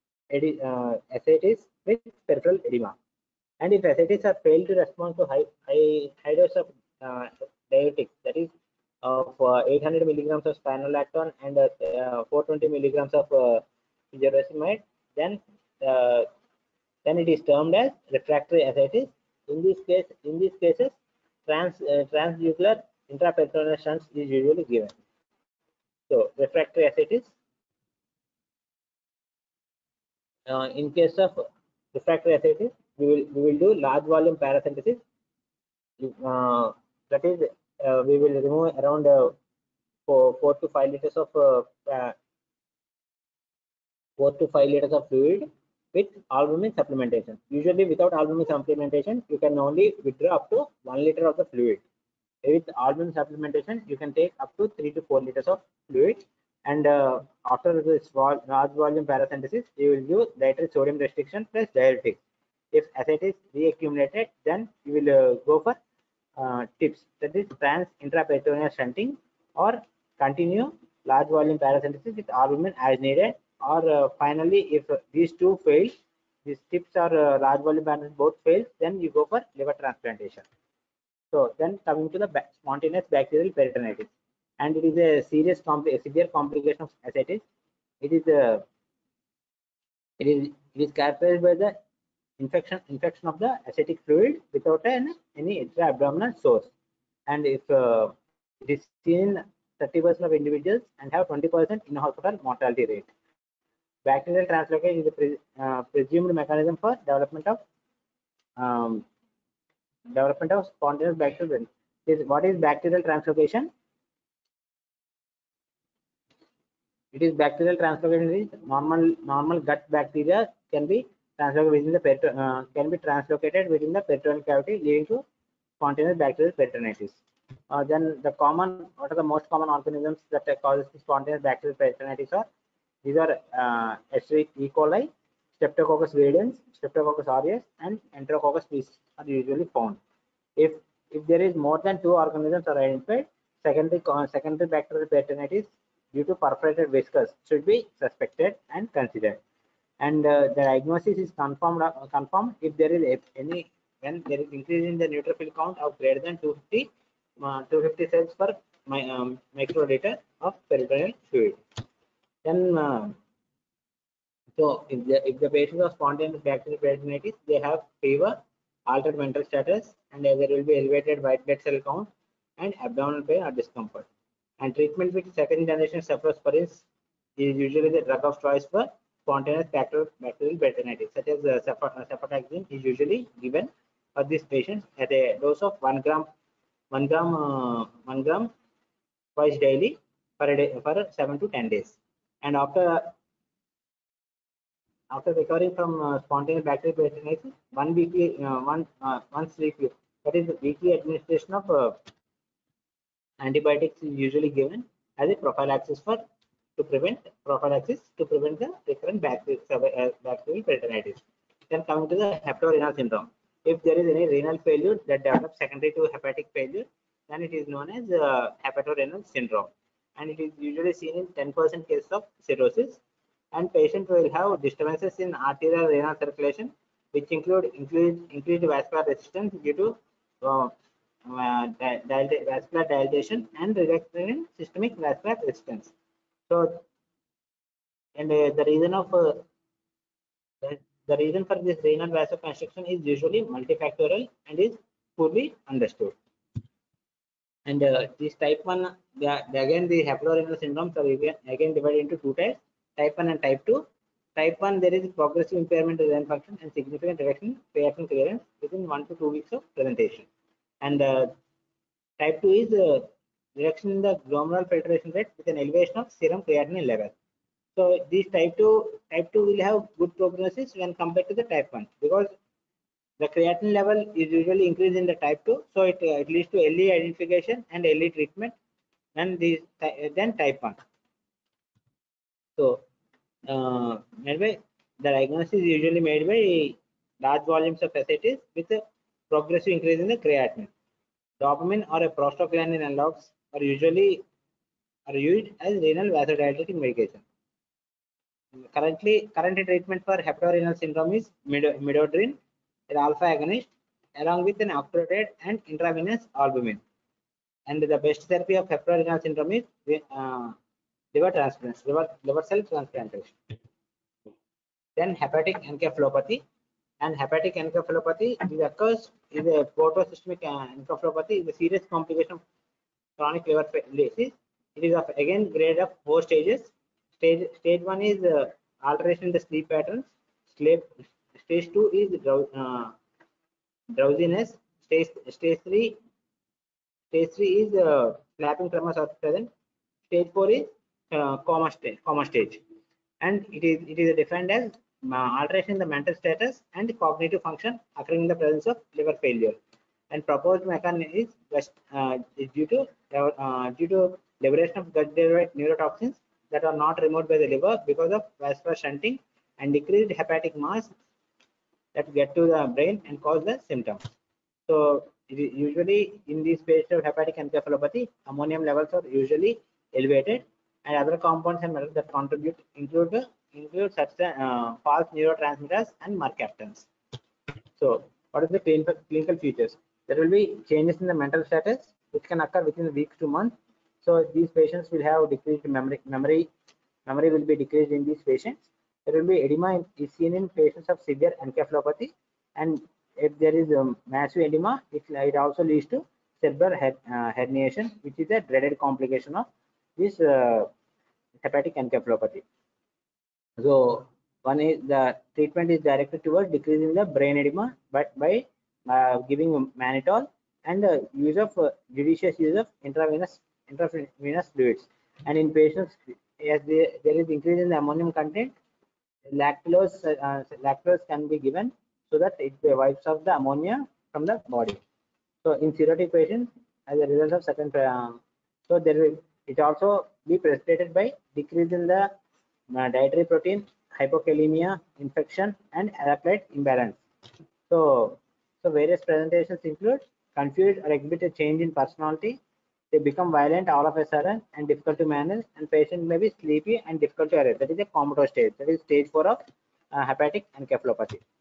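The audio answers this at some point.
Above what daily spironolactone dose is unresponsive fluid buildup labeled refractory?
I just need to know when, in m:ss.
0:09.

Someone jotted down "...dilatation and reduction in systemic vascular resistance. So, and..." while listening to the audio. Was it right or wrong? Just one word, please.
right.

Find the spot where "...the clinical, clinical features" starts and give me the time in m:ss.
6:18.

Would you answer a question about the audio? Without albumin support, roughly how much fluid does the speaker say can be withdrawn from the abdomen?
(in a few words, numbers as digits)
1 liter.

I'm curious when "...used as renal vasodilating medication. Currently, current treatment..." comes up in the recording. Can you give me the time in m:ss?
4:55.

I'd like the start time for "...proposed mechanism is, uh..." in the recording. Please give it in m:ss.
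5:50.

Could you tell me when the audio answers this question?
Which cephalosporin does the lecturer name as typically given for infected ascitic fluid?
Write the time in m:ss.
3:01.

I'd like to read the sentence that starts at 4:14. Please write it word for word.
Type 1, there is progressive impairment of renal function and significant reduction in creatinine clearance within 1 to 2 weeks of presentation.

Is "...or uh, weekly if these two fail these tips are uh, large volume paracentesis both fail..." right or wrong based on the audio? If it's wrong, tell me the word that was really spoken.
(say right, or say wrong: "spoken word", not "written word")
wrong: "finally", not "weekly".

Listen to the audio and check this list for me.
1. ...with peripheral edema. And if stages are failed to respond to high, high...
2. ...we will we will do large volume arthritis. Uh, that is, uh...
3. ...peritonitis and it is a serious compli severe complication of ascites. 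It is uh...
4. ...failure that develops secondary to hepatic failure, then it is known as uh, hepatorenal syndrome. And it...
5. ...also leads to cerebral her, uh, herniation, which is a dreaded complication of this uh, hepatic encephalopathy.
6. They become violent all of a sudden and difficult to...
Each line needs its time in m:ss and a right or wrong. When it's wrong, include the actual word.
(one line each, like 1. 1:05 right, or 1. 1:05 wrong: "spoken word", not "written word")
1. 0:01 wrong: "ascites", not "stages"
2. 0:32 wrong: "paracentesis", not "arthritis"
3. 1:23 right
4. 3:34 right
5. 6:35 right
6. 7:22 right.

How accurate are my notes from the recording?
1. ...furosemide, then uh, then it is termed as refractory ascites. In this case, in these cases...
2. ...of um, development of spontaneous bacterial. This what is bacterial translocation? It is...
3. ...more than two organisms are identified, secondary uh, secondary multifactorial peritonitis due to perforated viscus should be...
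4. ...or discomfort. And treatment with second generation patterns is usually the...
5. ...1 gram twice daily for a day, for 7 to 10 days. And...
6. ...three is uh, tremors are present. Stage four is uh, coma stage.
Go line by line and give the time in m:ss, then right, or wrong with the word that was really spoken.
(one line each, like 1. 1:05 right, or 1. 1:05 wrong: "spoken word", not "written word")
1. 0:14 right
2. 1:47 right
3. 2:21 wrong: "bacterial", not "multifactorial"
4. 2:53 wrong: "cephalosporins", not "patterns"
5. 3:08 right
6. 5:37 right.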